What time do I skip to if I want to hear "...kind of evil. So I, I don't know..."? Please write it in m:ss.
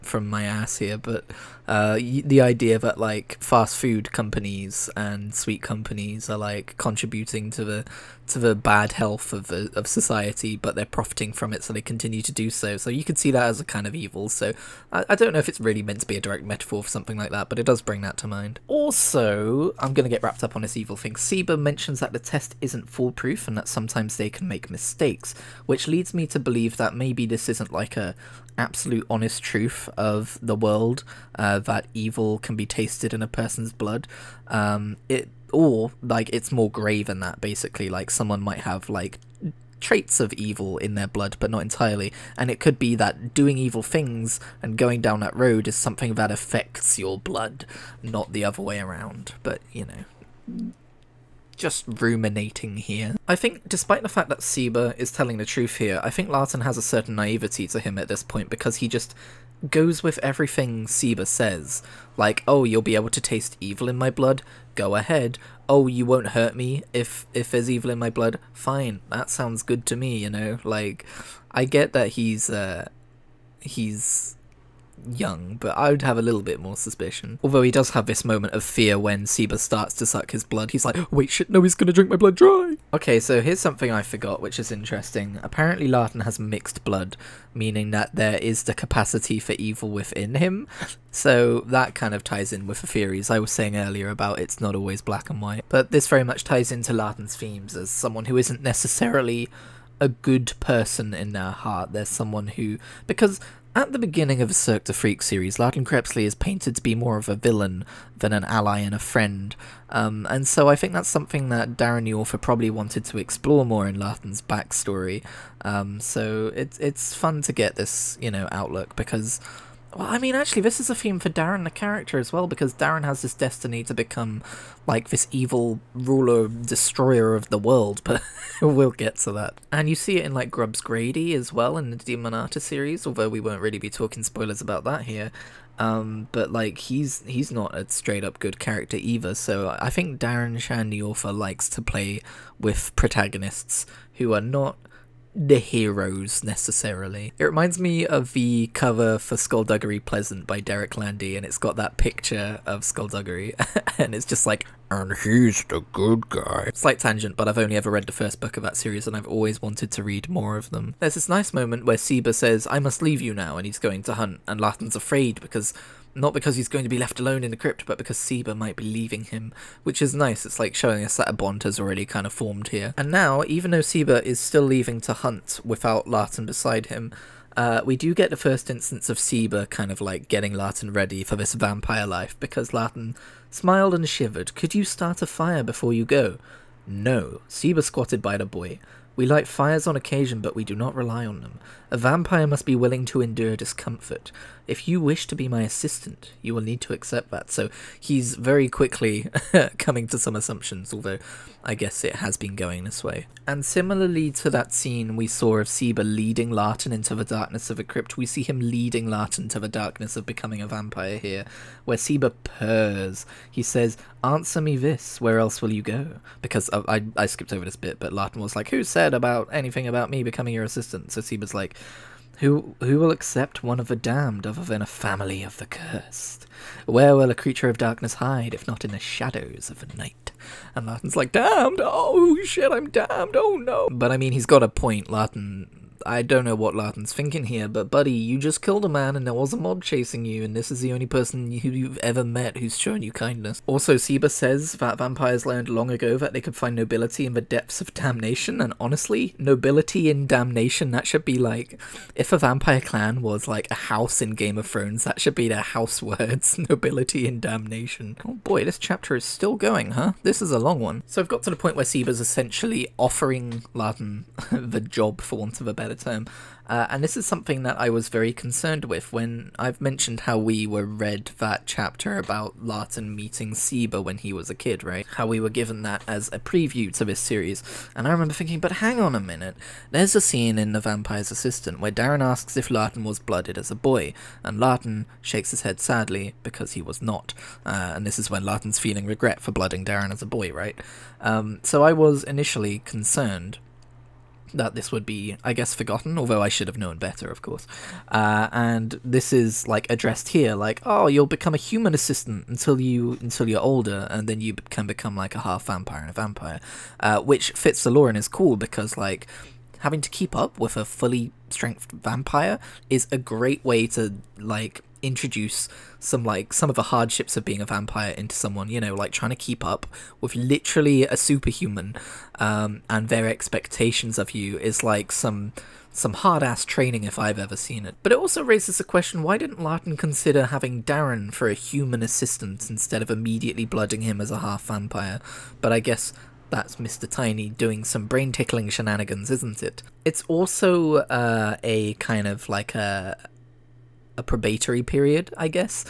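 0:13.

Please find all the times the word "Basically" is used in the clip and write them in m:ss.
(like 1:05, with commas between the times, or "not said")
0:37.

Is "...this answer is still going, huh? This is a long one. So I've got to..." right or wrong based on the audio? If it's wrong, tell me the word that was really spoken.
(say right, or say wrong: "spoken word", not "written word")
wrong: "chapter", not "answer".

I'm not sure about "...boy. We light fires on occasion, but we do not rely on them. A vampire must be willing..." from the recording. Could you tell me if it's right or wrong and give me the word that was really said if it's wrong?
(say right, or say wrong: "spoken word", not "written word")
right.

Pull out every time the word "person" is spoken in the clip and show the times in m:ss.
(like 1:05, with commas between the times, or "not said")
0:33, 1:40, 4:01.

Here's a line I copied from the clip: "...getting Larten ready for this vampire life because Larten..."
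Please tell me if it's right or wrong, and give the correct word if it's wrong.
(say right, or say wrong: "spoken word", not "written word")
right.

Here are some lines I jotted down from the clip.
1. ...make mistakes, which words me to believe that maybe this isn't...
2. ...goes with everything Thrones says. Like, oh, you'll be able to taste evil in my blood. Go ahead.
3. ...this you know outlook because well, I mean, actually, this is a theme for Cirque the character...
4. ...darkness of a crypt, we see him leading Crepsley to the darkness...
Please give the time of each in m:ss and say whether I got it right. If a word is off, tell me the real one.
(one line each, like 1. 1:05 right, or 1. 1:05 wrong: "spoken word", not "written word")
1. 0:24 wrong: "leads", not "words"
2. 0:59 wrong: "Seba", not "Thrones"
3. 1:57 wrong: "Darren", not "Cirque"
4. 3:27 wrong: "Larten", not "Crepsley".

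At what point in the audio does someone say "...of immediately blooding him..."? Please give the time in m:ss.
5:33.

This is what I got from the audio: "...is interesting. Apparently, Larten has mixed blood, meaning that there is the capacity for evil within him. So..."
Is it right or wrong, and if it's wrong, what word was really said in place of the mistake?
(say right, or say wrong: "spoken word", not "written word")
right.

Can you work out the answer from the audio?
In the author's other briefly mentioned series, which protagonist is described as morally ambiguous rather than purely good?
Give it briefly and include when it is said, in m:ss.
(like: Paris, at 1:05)
Grubbs Grady, at 2:10.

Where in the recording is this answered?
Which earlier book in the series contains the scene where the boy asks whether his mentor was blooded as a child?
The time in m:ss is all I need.
4:40.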